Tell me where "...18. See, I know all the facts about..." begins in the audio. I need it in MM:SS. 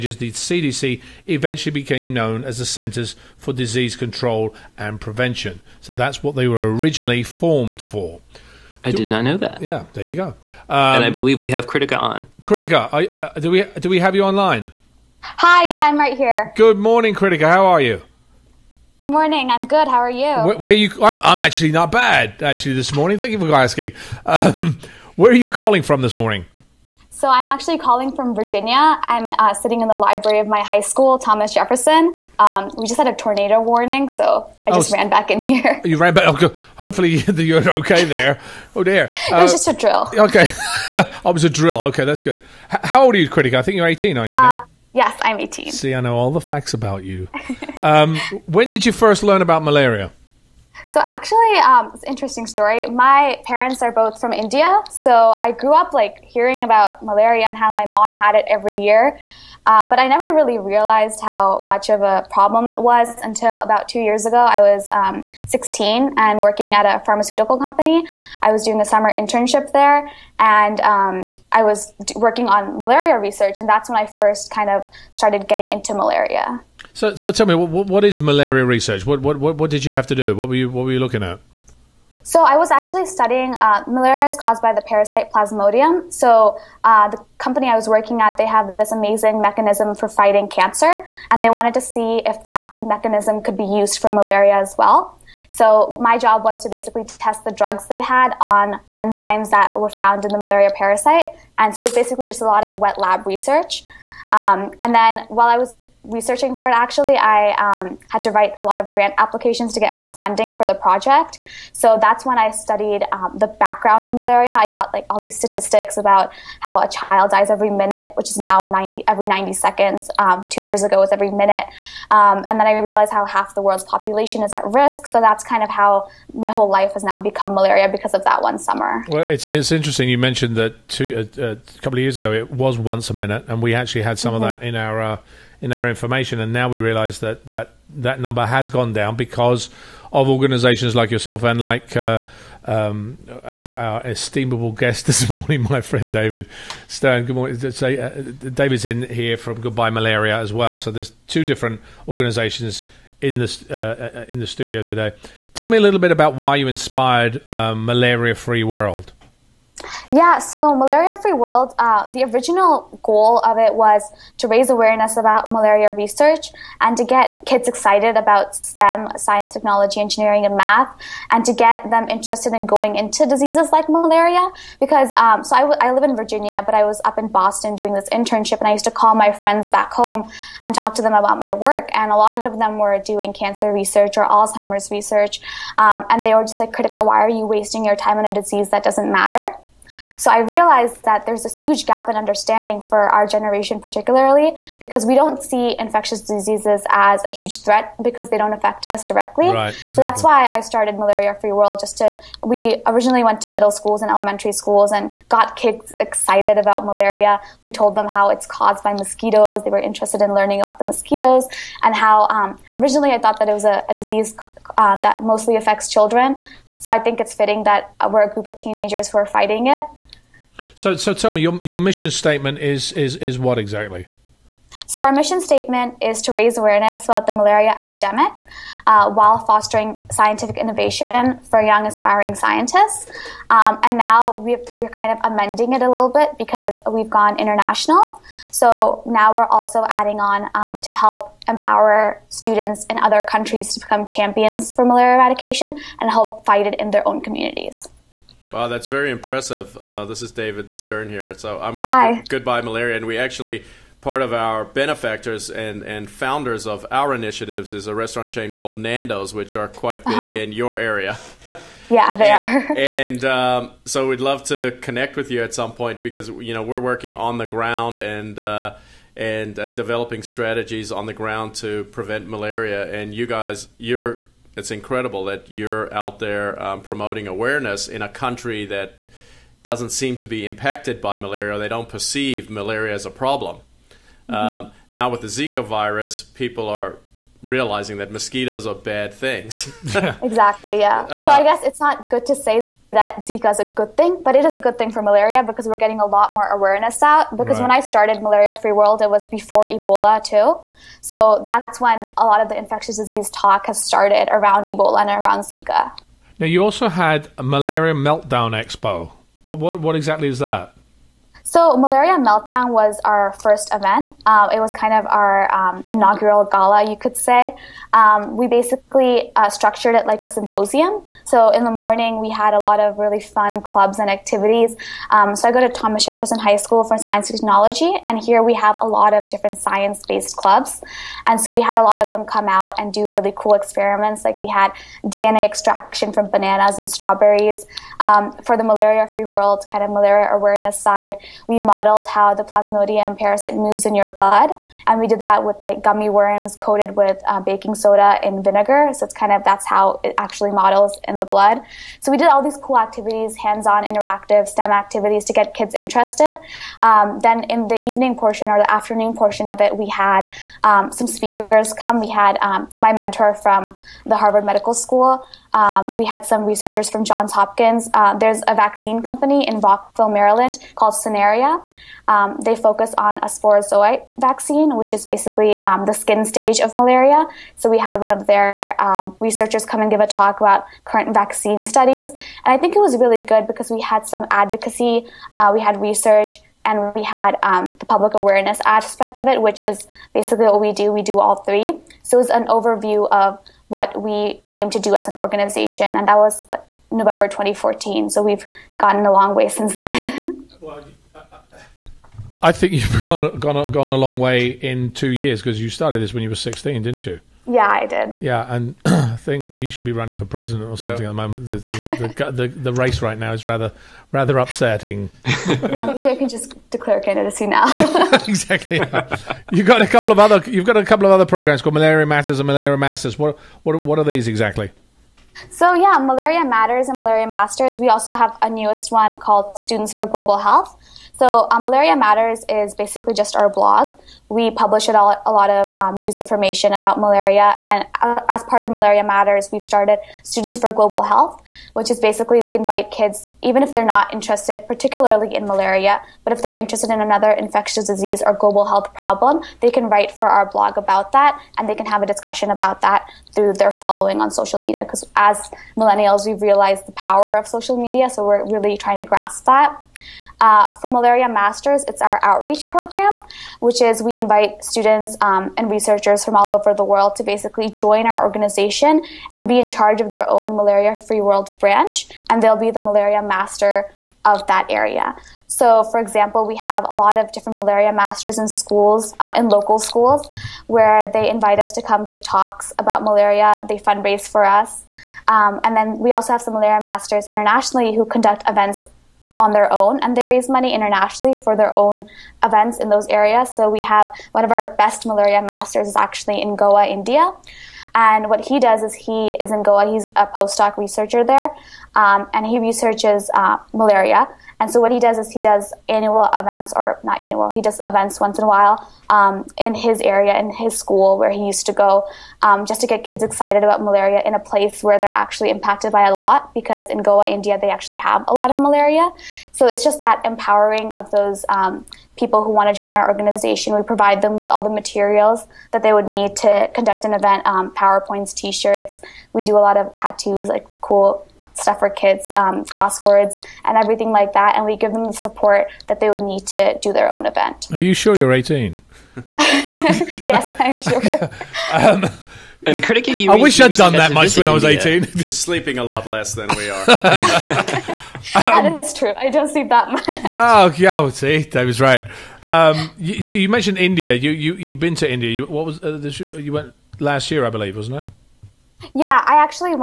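00:45.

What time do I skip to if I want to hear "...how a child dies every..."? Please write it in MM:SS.
01:56.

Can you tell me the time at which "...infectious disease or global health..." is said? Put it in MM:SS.
07:27.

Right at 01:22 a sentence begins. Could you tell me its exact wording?
So I was actually studying uh, malaria is caused by the parasite Plasmodium.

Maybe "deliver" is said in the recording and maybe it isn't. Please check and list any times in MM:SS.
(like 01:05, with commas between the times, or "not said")
not said.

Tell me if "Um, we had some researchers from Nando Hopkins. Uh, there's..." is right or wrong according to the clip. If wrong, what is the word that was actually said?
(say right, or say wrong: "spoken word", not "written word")
wrong: "Johns", not "Nando".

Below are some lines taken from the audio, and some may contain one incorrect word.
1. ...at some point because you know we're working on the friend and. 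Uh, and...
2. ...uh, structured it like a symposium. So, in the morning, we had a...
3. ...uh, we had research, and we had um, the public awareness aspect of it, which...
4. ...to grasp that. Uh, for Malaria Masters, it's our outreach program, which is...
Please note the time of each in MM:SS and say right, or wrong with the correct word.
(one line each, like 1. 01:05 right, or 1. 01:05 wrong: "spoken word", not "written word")
1. 04:25 wrong: "ground", not "friend"
2. 05:19 right
3. 06:25 right
4. 07:38 right.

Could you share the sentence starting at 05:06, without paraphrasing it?
Now, you also had a malaria meltdown expo.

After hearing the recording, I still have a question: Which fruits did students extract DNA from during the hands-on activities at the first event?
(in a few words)
Bananas and strawberries.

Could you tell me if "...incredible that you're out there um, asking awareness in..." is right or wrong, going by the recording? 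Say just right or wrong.
wrong.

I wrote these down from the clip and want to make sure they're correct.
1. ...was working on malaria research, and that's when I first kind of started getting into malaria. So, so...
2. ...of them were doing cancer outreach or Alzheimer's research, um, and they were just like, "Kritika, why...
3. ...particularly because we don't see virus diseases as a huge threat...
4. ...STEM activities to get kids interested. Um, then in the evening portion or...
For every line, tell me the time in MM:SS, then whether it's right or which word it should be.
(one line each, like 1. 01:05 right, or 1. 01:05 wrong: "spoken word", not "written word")
1. 01:11 right
2. 03:02 wrong: "research", not "outreach"
3. 03:13 wrong: "infectious", not "virus"
4. 05:54 right.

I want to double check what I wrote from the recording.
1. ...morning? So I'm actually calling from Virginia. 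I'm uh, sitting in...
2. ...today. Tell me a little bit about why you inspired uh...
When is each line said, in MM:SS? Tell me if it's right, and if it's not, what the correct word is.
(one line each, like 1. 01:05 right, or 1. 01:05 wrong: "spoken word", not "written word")
1. 00:26 right
2. 02:34 right.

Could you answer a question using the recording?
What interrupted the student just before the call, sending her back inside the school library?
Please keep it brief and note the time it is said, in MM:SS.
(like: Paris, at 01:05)
A tornado warning, at 00:33.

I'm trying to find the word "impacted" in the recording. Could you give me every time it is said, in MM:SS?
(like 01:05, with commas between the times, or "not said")
04:40, 08:35.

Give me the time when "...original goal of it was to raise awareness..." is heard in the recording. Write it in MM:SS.
02:42.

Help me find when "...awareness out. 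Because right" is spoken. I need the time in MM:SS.
04:56.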